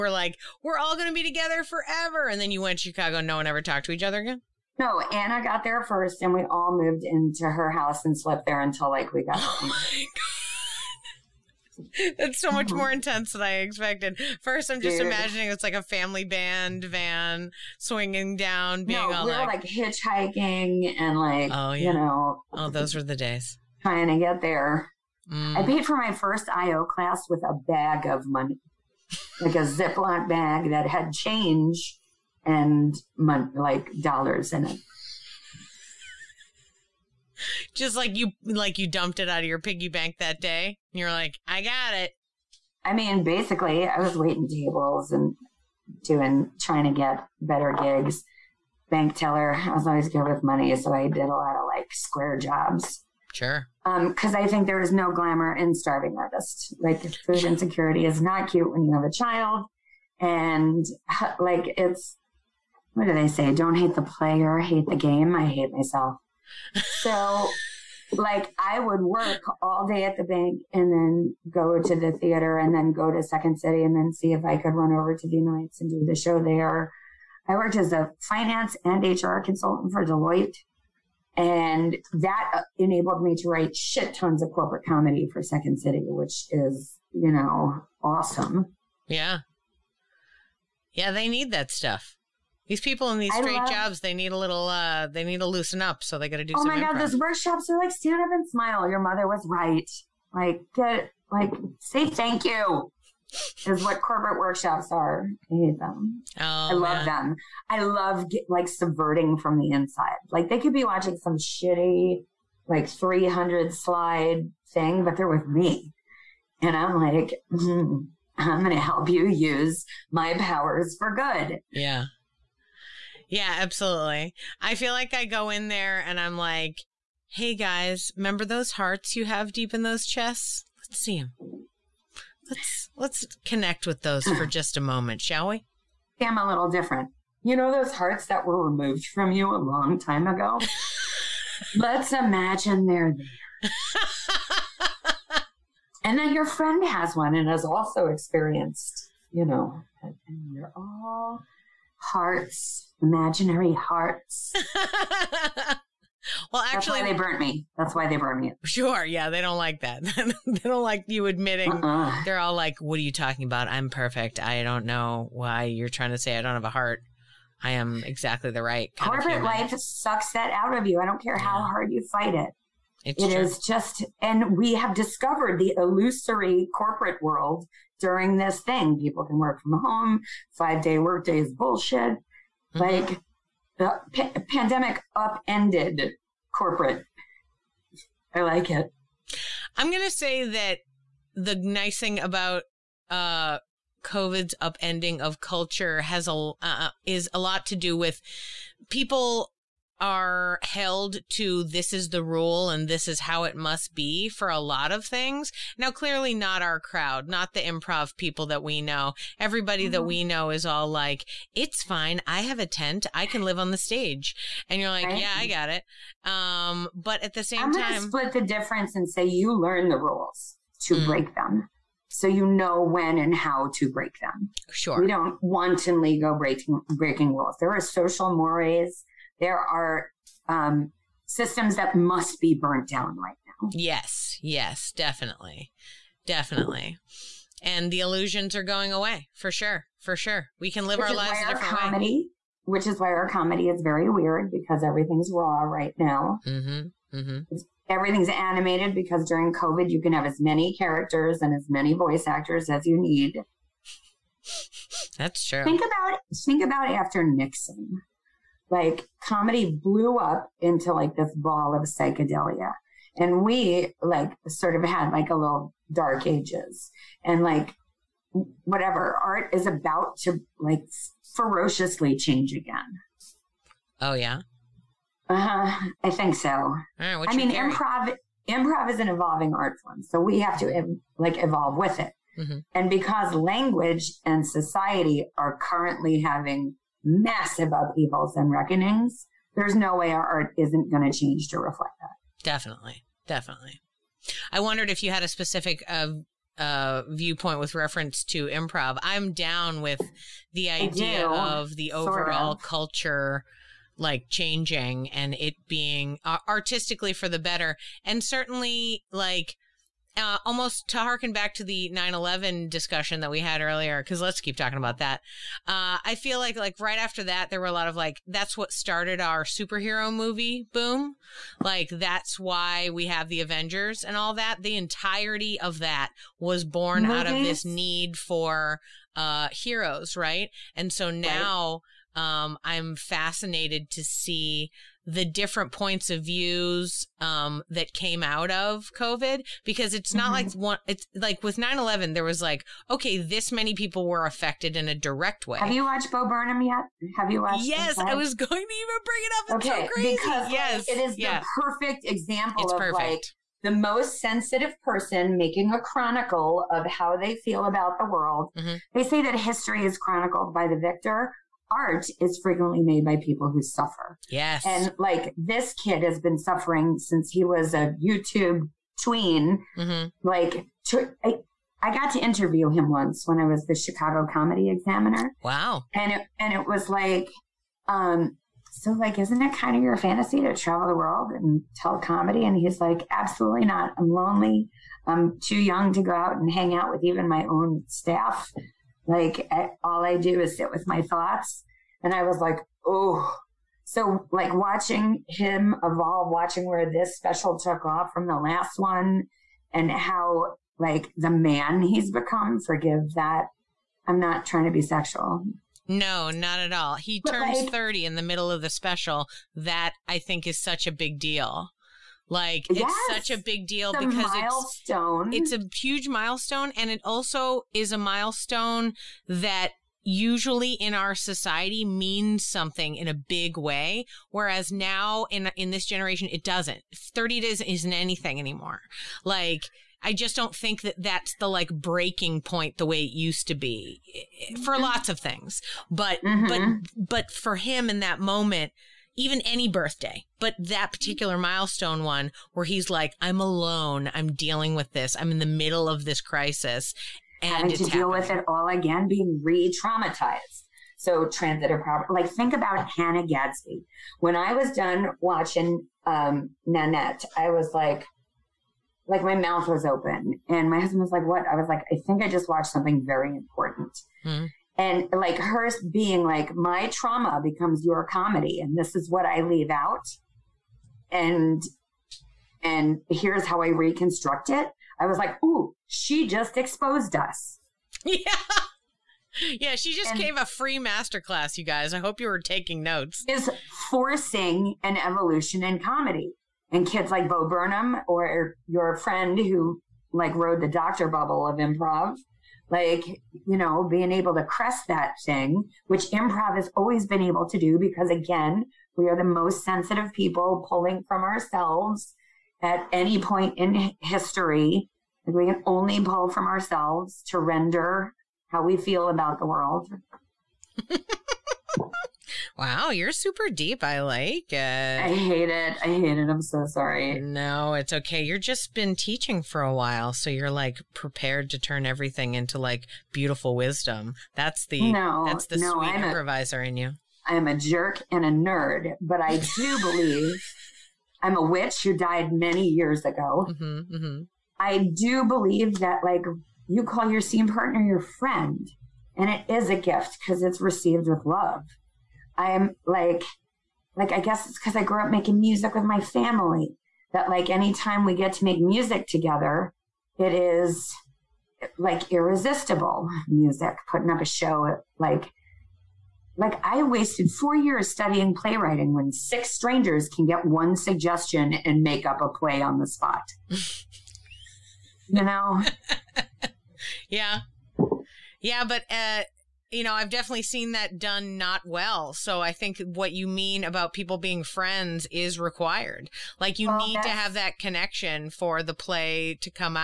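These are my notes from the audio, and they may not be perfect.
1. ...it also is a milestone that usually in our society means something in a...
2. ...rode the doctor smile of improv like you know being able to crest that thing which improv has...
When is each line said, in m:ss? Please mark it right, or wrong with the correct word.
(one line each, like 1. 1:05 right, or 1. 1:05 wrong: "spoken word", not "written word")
1. 6:56 right
2. 8:10 wrong: "bubble", not "smile".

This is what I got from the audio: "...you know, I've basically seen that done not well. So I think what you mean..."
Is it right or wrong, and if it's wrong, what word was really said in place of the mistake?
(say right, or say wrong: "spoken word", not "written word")
wrong: "definitely", not "basically".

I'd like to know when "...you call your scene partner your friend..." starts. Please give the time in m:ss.
8:56.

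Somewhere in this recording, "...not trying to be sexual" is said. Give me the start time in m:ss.
6:44.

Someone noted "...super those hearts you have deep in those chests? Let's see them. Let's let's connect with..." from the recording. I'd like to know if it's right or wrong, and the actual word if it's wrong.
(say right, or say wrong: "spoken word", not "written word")
wrong: "remember", not "super".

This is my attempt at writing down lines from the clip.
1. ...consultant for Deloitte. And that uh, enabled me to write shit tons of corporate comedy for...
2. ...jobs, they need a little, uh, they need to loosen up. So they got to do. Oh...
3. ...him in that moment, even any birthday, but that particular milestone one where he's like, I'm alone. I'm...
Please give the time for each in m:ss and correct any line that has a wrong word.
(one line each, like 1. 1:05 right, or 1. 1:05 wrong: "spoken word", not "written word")
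1. 1:19 right
2. 1:33 right
3. 7:17 right.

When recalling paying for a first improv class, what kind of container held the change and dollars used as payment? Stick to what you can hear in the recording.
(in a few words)
Ziploc bag.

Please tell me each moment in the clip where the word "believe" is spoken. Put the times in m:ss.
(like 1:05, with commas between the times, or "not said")
8:49, 8:55.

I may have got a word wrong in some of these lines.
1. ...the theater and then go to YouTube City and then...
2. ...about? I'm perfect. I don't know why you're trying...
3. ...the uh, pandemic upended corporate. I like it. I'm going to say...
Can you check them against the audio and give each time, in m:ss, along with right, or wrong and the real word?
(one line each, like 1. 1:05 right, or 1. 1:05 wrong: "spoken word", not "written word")
1. 1:11 wrong: "Second", not "YouTube"
2. 2:43 right
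3. 3:03 right.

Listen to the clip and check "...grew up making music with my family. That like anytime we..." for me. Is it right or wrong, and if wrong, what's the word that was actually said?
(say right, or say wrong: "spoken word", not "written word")
right.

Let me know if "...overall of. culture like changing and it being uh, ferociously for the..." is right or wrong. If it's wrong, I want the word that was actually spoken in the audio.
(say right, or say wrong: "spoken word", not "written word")
wrong: "artistically", not "ferociously".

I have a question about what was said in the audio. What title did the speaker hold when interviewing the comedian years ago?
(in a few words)
Chicago Comedy Examiner.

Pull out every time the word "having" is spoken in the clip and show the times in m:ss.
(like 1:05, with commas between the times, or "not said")
4:46, 7:27.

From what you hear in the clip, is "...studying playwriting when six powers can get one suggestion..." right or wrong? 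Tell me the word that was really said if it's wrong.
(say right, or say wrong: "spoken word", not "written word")
wrong: "strangers", not "powers".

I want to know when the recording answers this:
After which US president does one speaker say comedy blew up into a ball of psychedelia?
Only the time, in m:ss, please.
4:17.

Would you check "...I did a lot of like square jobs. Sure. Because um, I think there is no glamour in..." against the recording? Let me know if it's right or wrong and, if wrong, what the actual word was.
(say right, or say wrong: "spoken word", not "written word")
right.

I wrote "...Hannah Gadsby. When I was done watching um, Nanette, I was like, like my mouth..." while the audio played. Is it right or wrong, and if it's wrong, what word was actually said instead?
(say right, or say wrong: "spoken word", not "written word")
right.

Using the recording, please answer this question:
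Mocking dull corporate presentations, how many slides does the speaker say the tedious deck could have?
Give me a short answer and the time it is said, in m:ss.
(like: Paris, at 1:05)
300, at 1:52.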